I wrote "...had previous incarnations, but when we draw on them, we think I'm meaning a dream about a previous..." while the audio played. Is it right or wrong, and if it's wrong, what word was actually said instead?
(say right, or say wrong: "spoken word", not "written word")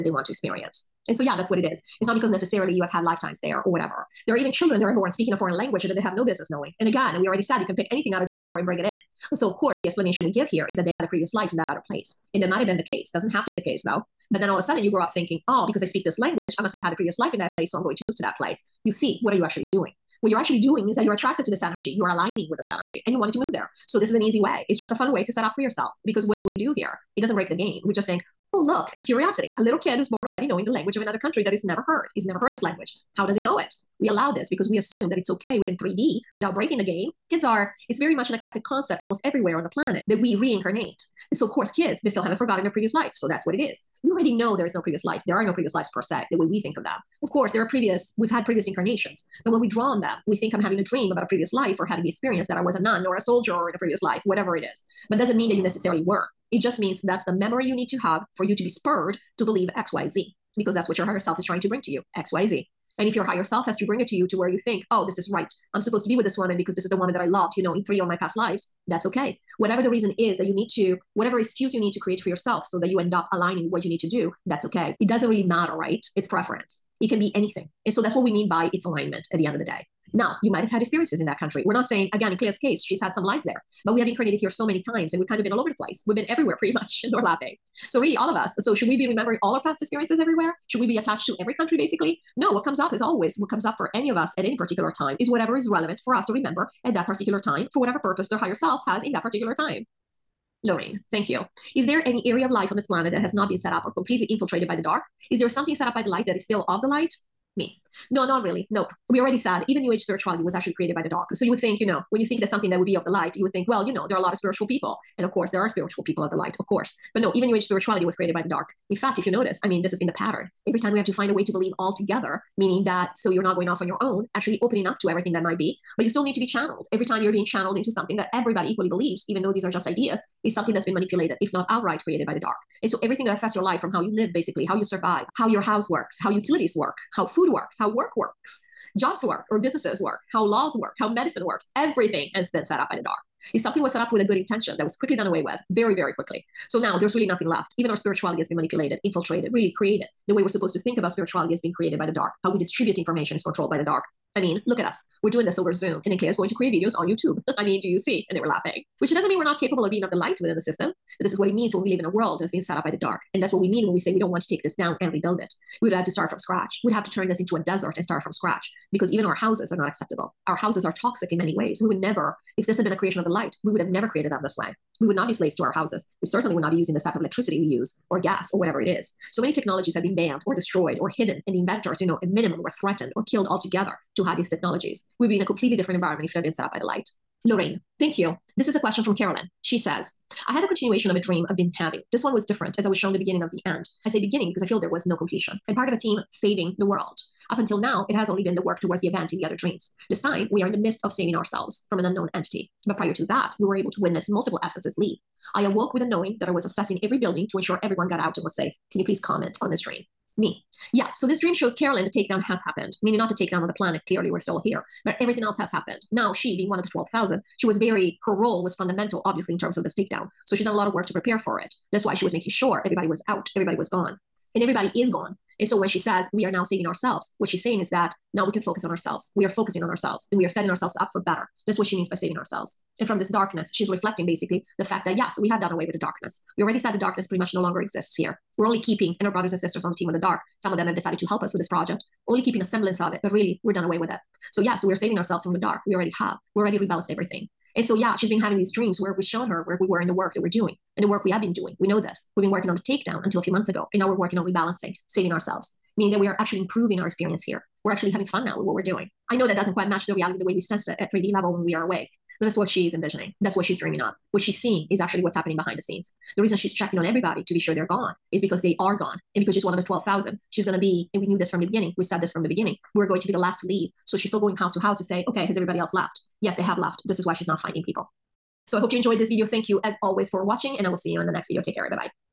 wrong: "having", not "meaning".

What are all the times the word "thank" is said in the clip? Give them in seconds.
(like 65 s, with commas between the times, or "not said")
101 s, 187 s, 279 s.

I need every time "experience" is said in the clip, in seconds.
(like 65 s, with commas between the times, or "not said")
0 s, 52 s, 80 s, 89 s, 257 s.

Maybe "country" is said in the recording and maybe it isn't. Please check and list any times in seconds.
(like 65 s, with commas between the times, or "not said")
31 s, 81 s, 91 s.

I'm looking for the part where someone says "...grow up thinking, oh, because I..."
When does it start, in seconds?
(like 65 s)
14 s.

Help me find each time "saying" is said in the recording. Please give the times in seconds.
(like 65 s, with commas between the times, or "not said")
81 s, 227 s.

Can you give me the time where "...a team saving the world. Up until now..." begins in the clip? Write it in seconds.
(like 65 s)
195 s.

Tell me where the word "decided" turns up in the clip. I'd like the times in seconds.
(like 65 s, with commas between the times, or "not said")
240 s.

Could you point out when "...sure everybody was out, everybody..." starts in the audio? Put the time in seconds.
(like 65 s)
222 s.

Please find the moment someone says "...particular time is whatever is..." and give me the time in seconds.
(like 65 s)
94 s.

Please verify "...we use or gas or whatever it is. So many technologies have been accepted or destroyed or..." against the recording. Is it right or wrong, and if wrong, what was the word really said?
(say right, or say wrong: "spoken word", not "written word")
wrong: "banned", not "accepted".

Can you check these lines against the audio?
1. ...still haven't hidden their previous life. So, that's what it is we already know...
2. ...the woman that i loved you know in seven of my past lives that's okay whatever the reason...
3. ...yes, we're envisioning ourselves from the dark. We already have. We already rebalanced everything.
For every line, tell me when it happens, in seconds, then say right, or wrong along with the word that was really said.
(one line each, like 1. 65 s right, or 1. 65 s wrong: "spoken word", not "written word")
1. 42 s wrong: "forgotten", not "hidden"
2. 66 s wrong: "three", not "seven"
3. 244 s wrong: "saving", not "envisioning".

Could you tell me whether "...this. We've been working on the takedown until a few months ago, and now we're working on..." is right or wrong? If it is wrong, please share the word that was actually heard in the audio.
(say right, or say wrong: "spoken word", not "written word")
right.